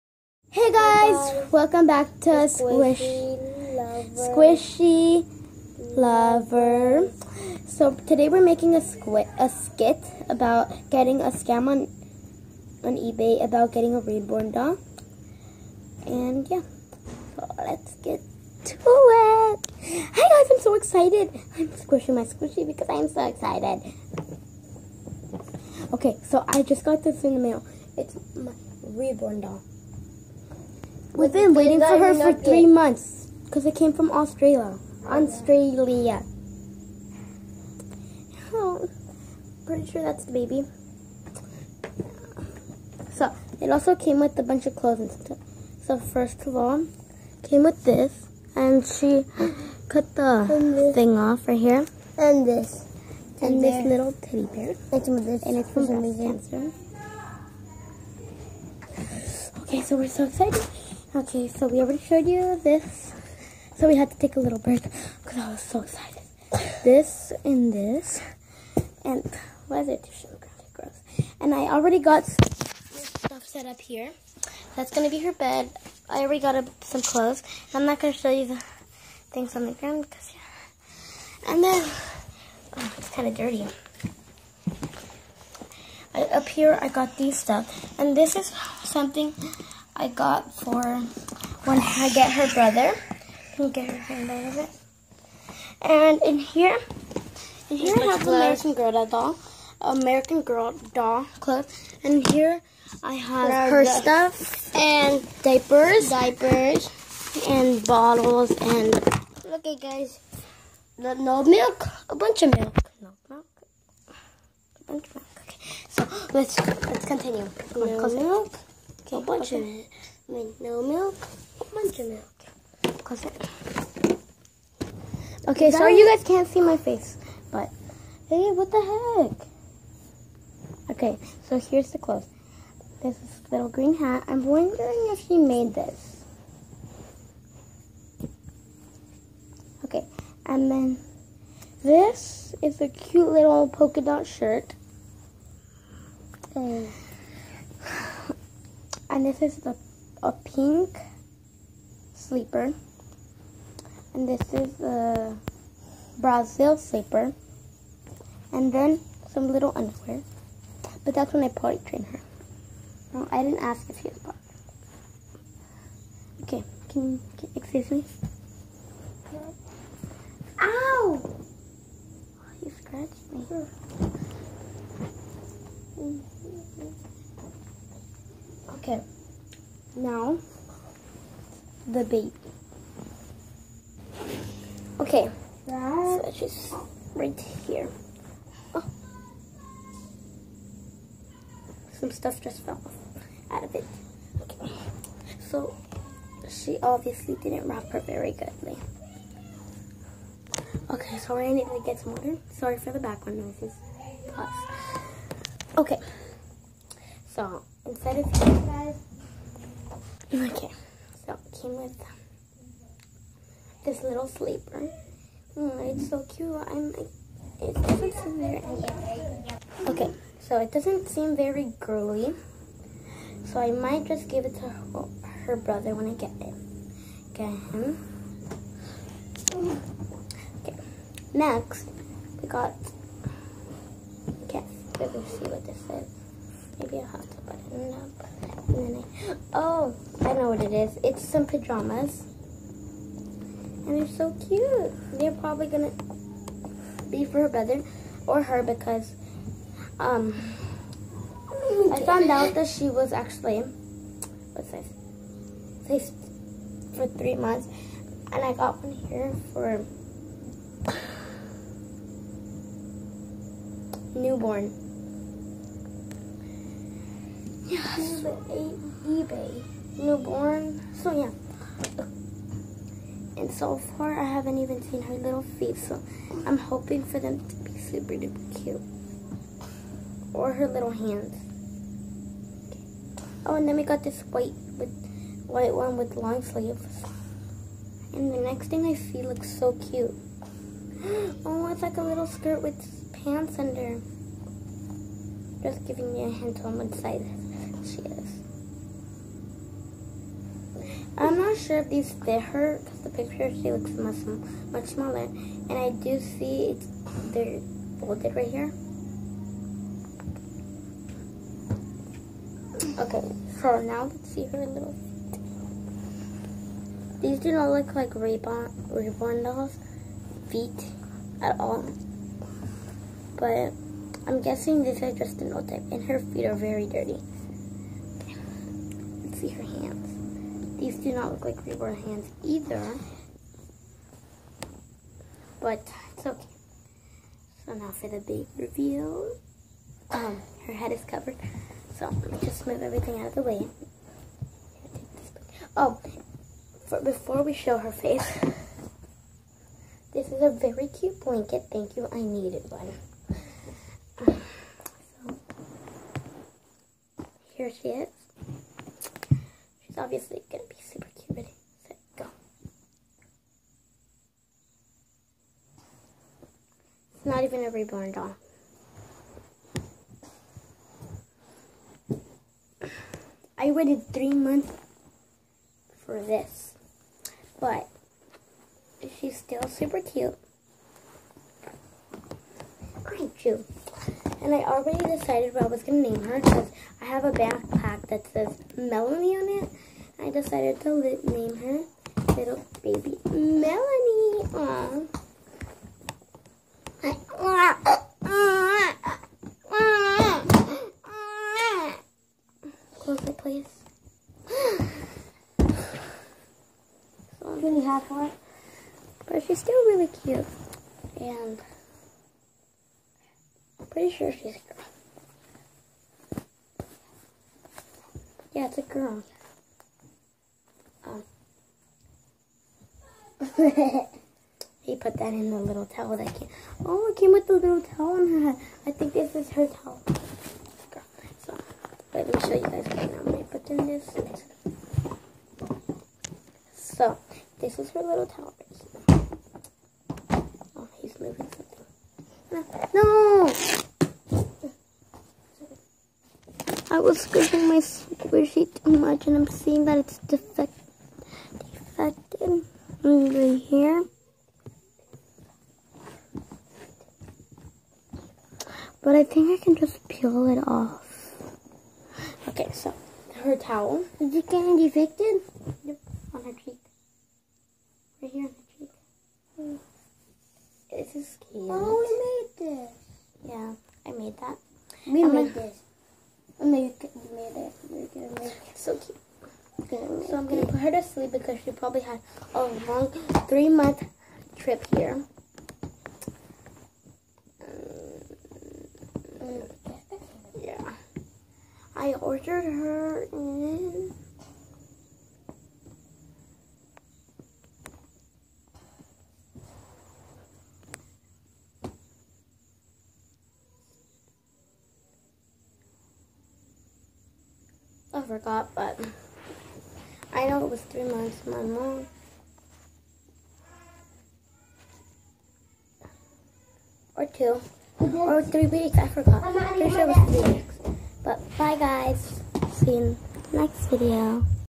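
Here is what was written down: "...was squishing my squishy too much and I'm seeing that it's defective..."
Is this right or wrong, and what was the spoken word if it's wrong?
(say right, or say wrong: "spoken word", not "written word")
right.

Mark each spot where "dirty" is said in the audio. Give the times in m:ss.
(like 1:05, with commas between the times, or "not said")
1:23, 5:26.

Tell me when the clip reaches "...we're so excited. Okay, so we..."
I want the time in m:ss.
0:59.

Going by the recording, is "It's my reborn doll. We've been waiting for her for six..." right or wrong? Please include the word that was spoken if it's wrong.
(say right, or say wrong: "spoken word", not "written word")
wrong: "three", not "six".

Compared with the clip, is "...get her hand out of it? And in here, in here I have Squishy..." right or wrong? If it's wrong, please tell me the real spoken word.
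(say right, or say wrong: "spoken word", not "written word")
wrong: "American", not "Squishy".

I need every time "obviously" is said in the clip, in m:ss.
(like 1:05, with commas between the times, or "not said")
3:16, 6:00.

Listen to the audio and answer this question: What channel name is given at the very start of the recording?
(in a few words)
Squish, Squishy Lover.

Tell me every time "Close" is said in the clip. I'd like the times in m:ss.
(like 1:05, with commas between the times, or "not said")
6:42.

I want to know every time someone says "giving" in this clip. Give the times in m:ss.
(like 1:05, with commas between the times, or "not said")
4:55.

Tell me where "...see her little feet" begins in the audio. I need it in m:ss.
5:14.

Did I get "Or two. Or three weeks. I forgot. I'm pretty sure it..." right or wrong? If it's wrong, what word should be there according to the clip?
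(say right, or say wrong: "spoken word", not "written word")
right.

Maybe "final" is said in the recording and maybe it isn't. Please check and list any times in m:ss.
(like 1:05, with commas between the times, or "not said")
not said.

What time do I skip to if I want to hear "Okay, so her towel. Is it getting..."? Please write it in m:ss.
7:42.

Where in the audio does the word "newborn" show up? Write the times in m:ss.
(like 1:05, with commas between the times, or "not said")
4:24, 4:29.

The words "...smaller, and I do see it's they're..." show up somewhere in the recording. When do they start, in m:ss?
5:04.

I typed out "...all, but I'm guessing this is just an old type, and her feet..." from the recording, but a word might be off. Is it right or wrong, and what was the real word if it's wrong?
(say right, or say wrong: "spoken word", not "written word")
right.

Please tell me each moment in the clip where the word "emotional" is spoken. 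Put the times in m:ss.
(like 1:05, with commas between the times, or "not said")
not said.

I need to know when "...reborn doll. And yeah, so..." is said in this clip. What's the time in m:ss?
0:14.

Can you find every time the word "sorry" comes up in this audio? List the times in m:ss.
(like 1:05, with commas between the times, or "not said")
2:05, 3:22.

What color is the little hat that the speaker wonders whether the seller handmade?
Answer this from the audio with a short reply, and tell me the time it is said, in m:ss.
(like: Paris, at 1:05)
green, at 2:13.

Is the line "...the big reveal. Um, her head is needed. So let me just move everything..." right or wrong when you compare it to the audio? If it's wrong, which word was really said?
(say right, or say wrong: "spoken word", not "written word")
wrong: "covered", not "needed".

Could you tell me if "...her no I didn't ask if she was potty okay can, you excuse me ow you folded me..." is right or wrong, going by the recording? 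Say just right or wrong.
wrong.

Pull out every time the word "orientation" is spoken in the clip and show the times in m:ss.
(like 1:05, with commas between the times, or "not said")
not said.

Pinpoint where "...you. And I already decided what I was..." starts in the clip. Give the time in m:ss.
6:23.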